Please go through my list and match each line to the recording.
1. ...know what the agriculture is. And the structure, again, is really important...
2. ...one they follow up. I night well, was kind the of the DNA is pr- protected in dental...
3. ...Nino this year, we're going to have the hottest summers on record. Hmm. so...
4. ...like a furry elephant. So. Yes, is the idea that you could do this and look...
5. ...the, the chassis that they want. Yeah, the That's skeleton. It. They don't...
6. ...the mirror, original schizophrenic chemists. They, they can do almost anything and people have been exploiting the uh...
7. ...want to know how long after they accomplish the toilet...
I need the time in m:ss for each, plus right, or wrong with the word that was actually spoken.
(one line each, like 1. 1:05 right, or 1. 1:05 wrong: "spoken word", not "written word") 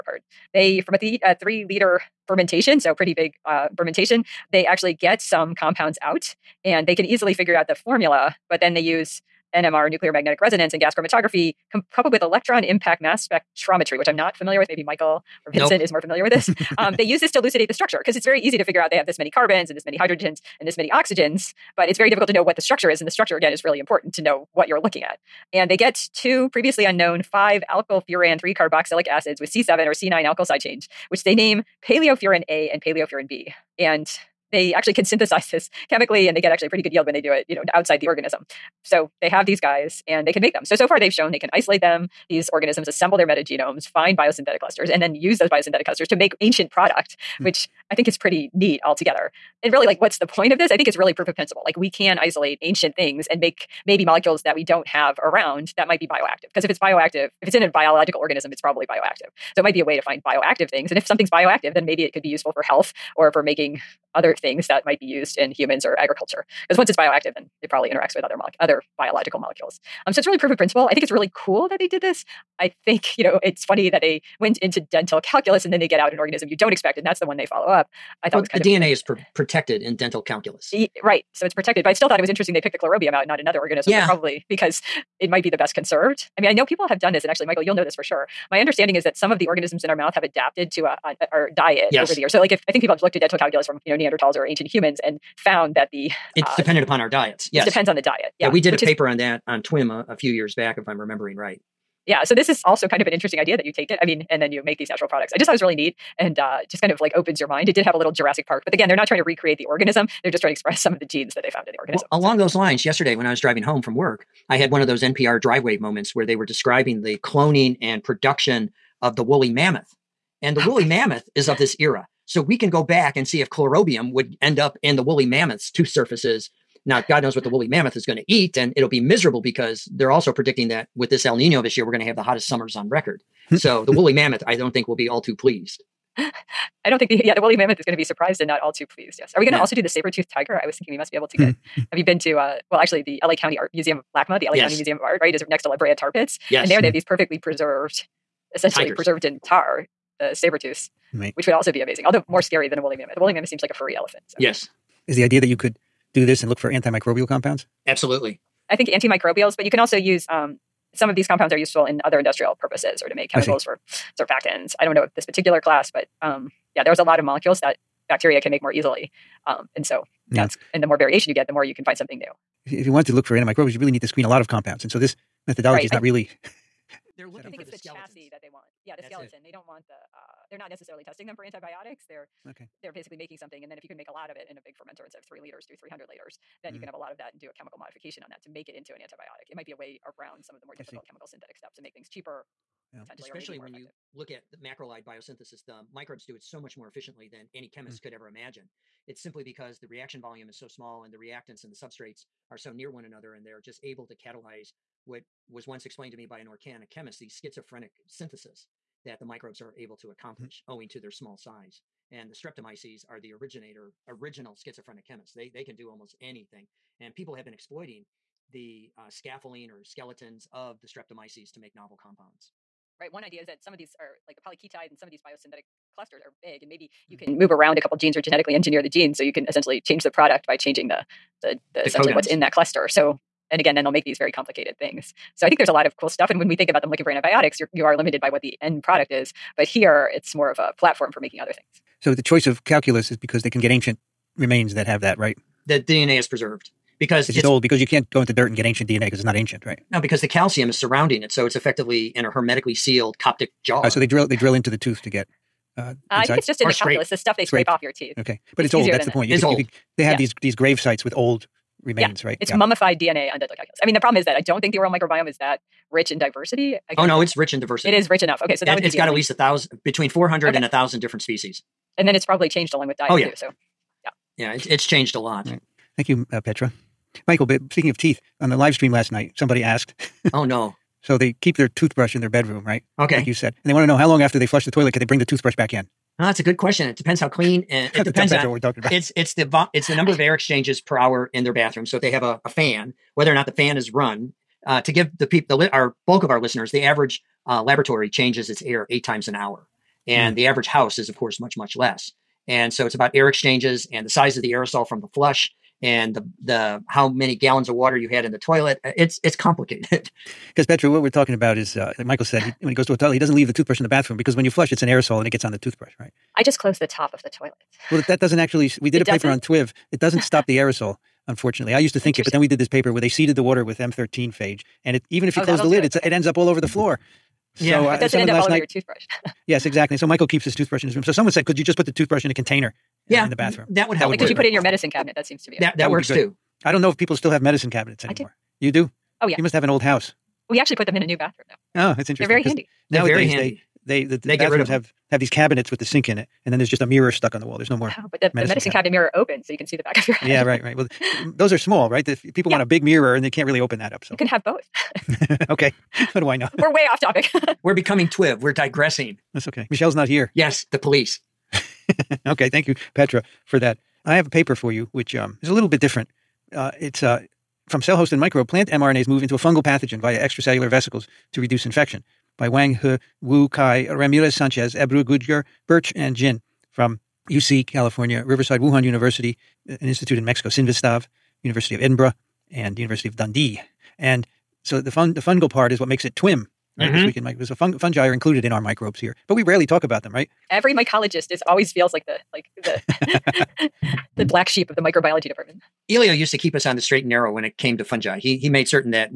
1. 0:22 wrong: "structure", not "agriculture"
2. 1:17 wrong: "thought", not "night"
3. 2:11 right
4. 2:33 right
5. 2:57 right
6. 3:33 wrong: "originator", not "mirror"
7. 4:43 wrong: "flush", not "accomplish".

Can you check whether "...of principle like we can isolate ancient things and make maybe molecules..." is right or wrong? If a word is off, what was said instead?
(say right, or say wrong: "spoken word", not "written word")
right.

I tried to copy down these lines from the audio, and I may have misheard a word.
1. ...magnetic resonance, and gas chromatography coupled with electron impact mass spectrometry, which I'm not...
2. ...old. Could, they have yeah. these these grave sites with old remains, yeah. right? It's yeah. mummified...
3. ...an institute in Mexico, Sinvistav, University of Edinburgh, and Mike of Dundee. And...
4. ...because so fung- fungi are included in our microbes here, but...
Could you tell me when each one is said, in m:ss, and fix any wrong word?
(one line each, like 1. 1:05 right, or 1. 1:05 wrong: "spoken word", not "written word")
1. 0:10 right
2. 4:19 right
3. 6:19 wrong: "University", not "Mike"
4. 6:27 right.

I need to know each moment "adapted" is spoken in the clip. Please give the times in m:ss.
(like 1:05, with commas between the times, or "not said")
1:30.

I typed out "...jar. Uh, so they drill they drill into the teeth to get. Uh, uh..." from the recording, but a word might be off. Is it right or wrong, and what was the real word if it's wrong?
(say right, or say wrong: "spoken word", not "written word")
wrong: "tooth", not "teeth".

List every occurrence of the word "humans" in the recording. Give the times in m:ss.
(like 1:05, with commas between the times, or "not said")
1:05, 1:34.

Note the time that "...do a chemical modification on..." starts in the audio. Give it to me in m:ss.
3:07.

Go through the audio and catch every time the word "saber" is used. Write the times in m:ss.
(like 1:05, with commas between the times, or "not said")
2:19, 2:30.